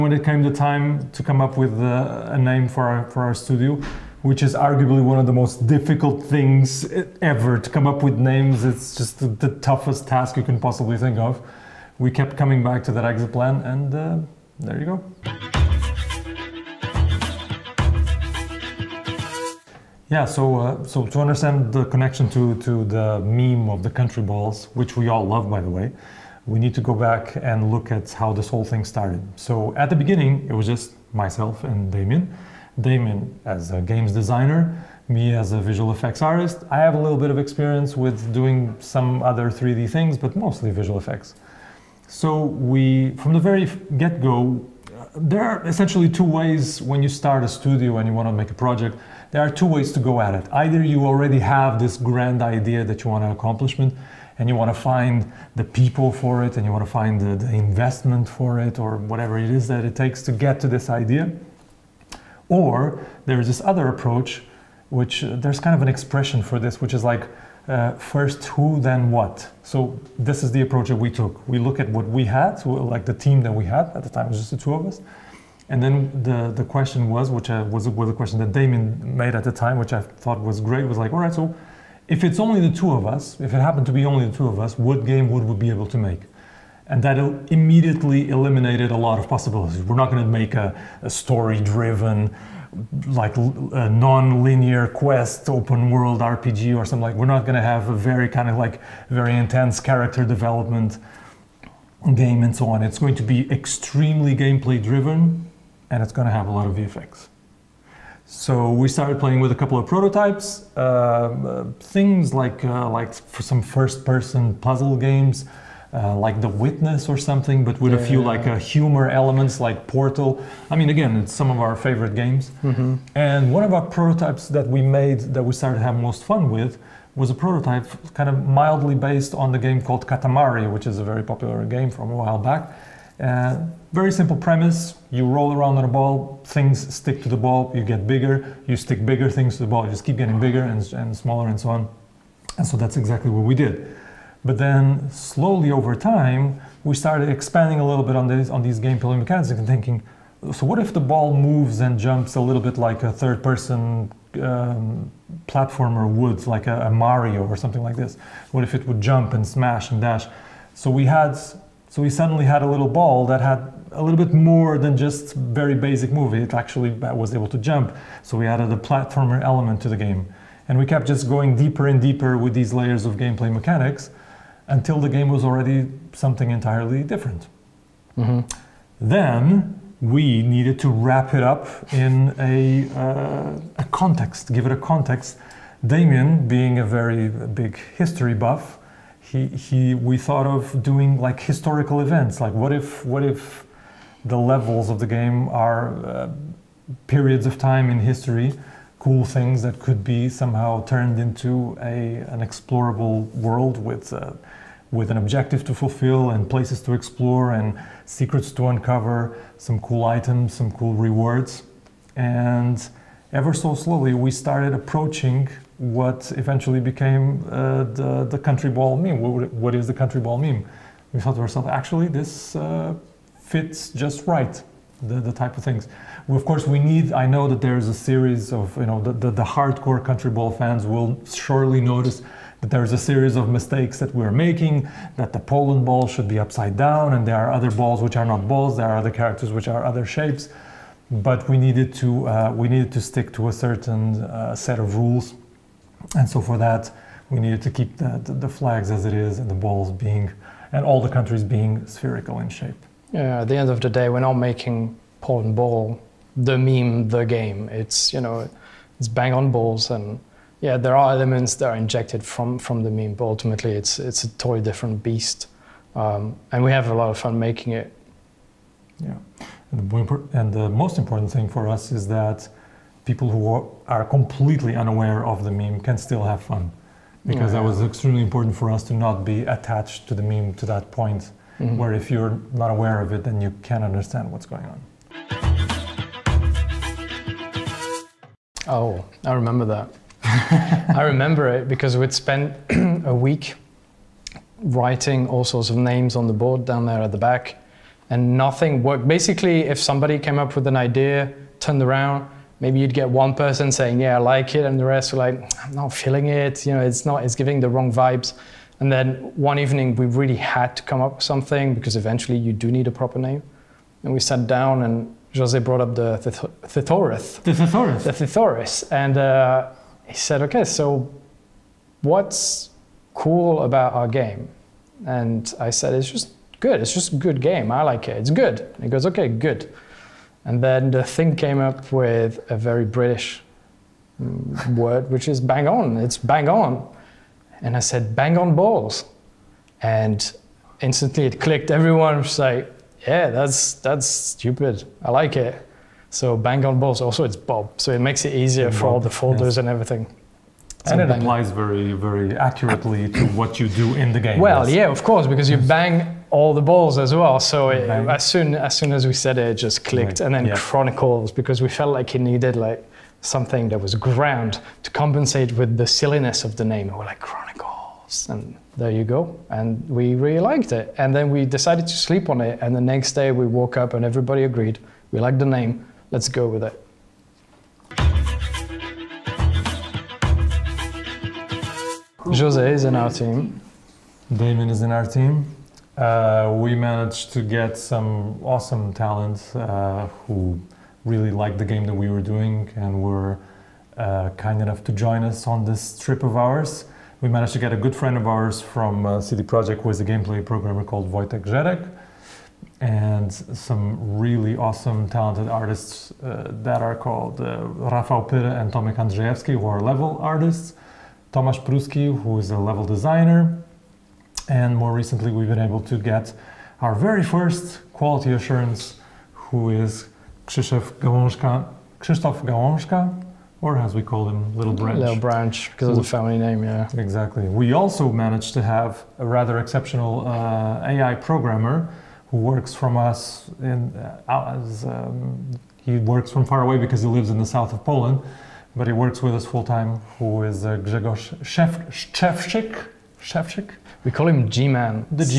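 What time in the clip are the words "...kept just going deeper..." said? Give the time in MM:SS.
02:50.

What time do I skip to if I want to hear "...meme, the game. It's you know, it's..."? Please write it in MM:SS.
04:16.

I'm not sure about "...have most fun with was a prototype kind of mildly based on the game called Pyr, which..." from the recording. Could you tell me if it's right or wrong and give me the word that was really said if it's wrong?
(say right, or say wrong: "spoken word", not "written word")
wrong: "Katamari", not "Pyr".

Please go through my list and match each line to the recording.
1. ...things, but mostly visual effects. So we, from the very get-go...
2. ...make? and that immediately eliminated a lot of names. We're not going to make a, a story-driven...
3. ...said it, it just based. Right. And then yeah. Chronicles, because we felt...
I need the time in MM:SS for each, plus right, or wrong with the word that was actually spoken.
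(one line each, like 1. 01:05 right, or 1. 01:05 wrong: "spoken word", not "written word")
1. 00:39 right
2. 01:25 wrong: "possibilities", not "names"
3. 05:59 wrong: "clicked", not "based".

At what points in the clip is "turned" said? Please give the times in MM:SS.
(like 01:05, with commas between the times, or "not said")
03:20, 05:01.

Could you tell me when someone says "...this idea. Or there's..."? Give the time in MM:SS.
01:00.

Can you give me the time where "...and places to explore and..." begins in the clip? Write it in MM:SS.
03:26.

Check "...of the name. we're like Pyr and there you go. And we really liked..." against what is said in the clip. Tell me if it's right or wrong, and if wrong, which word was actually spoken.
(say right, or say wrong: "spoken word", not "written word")
wrong: "Chronicles", not "Pyr".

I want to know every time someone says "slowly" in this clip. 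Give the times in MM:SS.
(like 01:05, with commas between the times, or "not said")
02:25, 03:33.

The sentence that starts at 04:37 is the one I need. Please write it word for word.
that was extremely important for us to not be attached to the meme to that point mm -hmm.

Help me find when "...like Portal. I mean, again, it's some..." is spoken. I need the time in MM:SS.
01:59.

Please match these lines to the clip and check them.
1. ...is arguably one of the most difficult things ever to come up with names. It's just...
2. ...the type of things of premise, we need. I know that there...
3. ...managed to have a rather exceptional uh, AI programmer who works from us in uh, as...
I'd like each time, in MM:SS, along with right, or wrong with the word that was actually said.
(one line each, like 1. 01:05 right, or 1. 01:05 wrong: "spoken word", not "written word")
1. 00:04 right
2. 03:45 wrong: "course", not "premise"
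3. 07:08 right.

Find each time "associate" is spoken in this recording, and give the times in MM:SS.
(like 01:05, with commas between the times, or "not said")
not said.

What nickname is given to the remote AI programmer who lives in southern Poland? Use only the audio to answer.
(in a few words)
G-Man.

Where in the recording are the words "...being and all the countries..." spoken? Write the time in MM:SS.
04:09.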